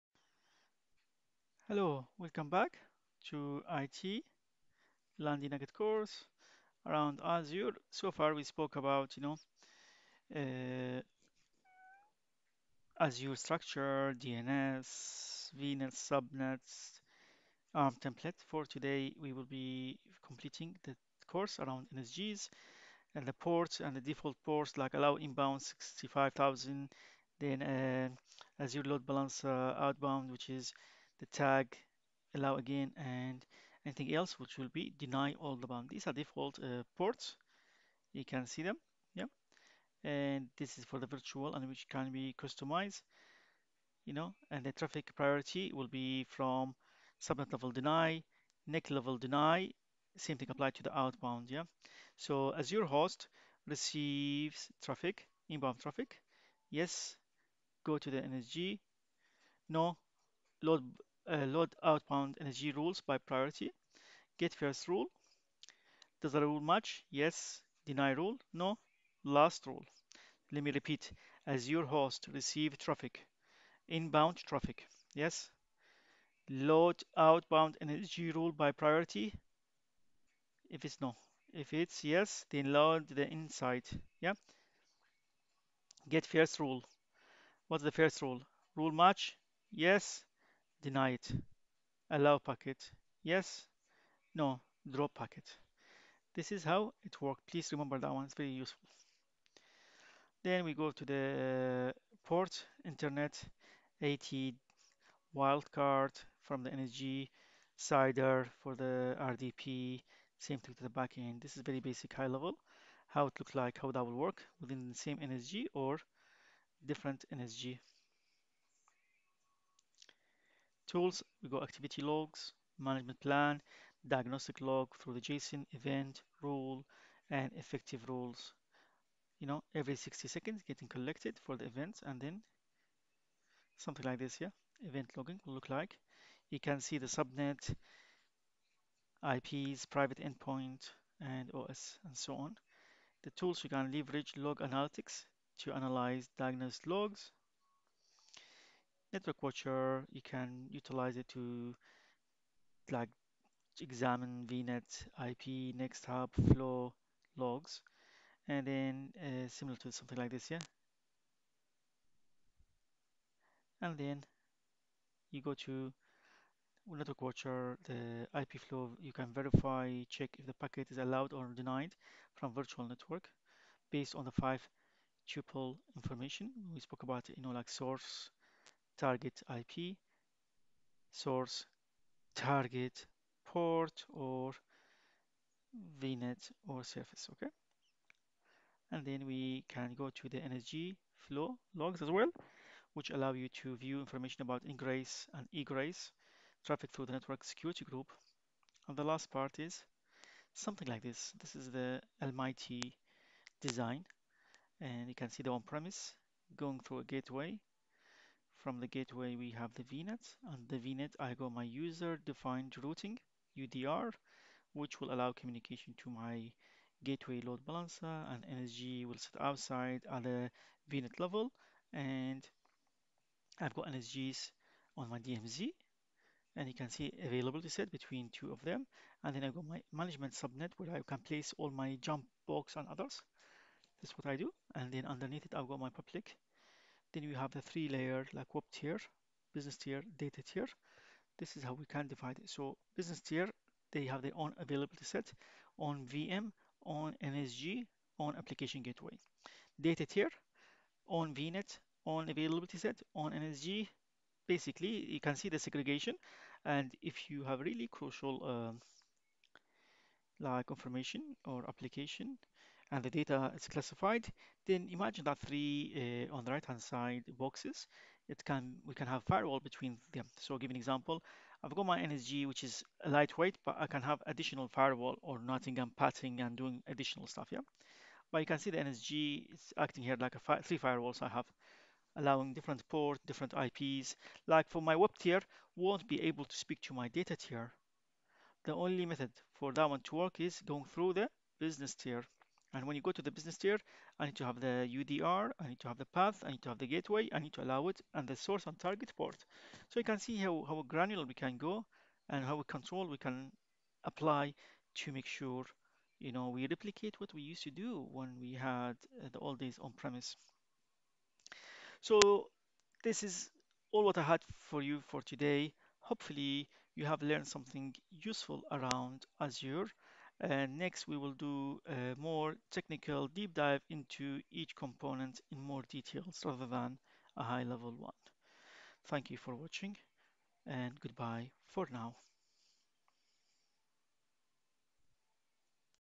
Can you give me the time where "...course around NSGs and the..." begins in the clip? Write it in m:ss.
0:21.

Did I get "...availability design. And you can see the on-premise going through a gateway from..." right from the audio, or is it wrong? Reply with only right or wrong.
wrong.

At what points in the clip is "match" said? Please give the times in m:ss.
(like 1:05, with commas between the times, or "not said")
1:06, 1:28.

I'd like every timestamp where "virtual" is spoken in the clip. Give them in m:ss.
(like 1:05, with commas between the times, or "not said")
0:41, 2:52.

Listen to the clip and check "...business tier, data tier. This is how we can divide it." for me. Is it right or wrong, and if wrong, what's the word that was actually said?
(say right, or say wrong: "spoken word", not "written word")
right.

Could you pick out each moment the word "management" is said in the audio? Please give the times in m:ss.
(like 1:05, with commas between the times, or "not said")
2:02, 3:49.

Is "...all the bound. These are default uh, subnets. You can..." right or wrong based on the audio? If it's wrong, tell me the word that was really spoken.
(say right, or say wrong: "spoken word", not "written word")
wrong: "ports", not "subnets".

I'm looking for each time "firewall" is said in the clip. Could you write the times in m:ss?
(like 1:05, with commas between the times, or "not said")
4:29, 4:34, 4:40.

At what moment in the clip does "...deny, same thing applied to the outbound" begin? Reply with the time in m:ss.
0:49.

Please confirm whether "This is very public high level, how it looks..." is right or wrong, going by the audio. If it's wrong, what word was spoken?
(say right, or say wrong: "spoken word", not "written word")
wrong: "basic", not "public".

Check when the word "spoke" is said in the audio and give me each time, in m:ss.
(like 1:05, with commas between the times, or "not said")
0:08, 2:56.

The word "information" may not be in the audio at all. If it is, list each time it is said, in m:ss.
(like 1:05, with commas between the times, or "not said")
2:55, 3:13, 4:20.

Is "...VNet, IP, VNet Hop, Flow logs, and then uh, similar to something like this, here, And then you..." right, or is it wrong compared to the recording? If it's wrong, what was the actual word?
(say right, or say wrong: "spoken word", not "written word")
wrong: "Next", not "VNet".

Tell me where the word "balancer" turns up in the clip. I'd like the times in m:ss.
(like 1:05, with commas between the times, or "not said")
0:29, 3:37.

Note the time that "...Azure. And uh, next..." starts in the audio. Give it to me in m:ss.
5:19.